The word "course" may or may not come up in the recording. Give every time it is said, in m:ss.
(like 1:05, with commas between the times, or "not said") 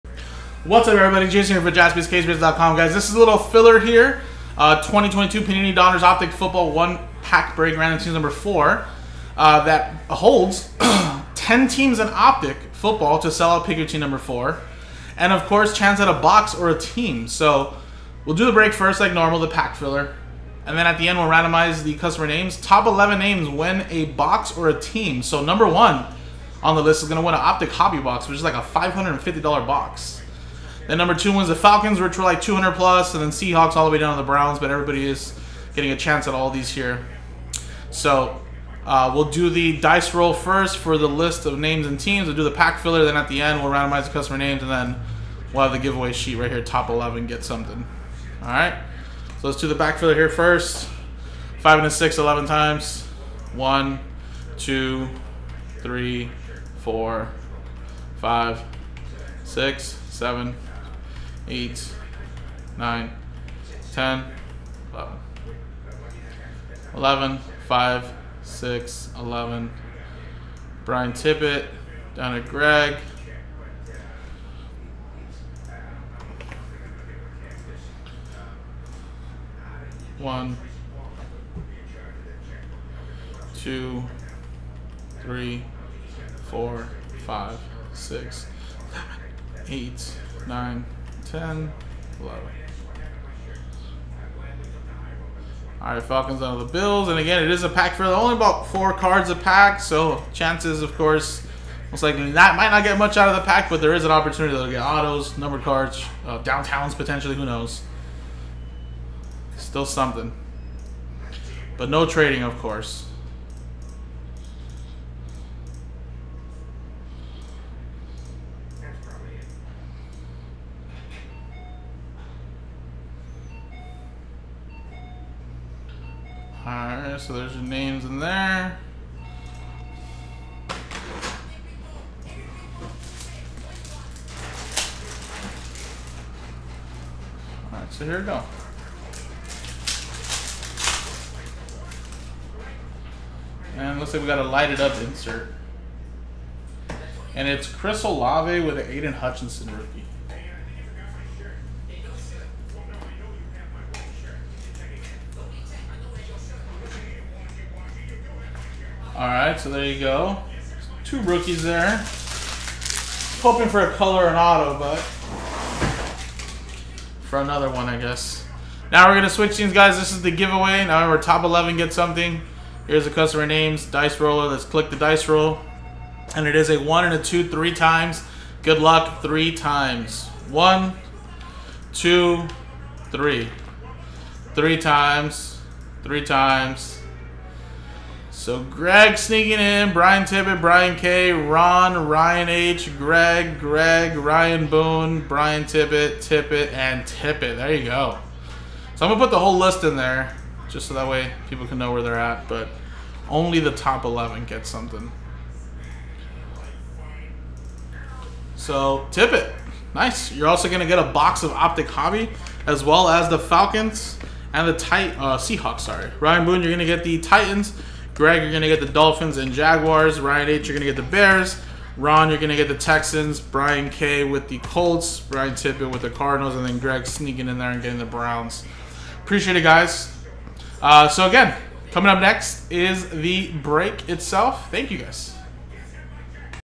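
0:15, 1:40, 1:52.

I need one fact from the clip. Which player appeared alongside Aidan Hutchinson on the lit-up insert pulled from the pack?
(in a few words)
Chris Olave.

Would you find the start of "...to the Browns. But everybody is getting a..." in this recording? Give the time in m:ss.
0:34.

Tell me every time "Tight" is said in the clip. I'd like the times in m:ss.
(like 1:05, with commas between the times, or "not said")
3:34.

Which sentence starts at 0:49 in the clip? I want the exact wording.
So let's do the back filler here first.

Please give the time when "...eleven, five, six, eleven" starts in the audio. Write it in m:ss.
1:06.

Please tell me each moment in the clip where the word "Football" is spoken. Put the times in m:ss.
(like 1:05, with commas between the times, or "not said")
0:06, 0:12.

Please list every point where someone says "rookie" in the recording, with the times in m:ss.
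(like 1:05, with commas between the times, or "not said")
2:29, 2:41.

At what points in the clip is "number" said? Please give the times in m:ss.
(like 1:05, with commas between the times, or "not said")
0:08, 0:13, 0:25, 0:30, 1:45.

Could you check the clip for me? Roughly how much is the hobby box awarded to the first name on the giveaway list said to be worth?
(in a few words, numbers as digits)
$550.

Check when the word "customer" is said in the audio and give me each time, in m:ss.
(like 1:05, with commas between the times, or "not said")
0:21, 0:44, 2:53.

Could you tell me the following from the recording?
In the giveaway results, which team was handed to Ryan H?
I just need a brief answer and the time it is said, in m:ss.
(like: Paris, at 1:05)
Bears, at 3:41.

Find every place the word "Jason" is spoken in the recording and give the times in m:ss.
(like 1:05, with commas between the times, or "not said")
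0:01.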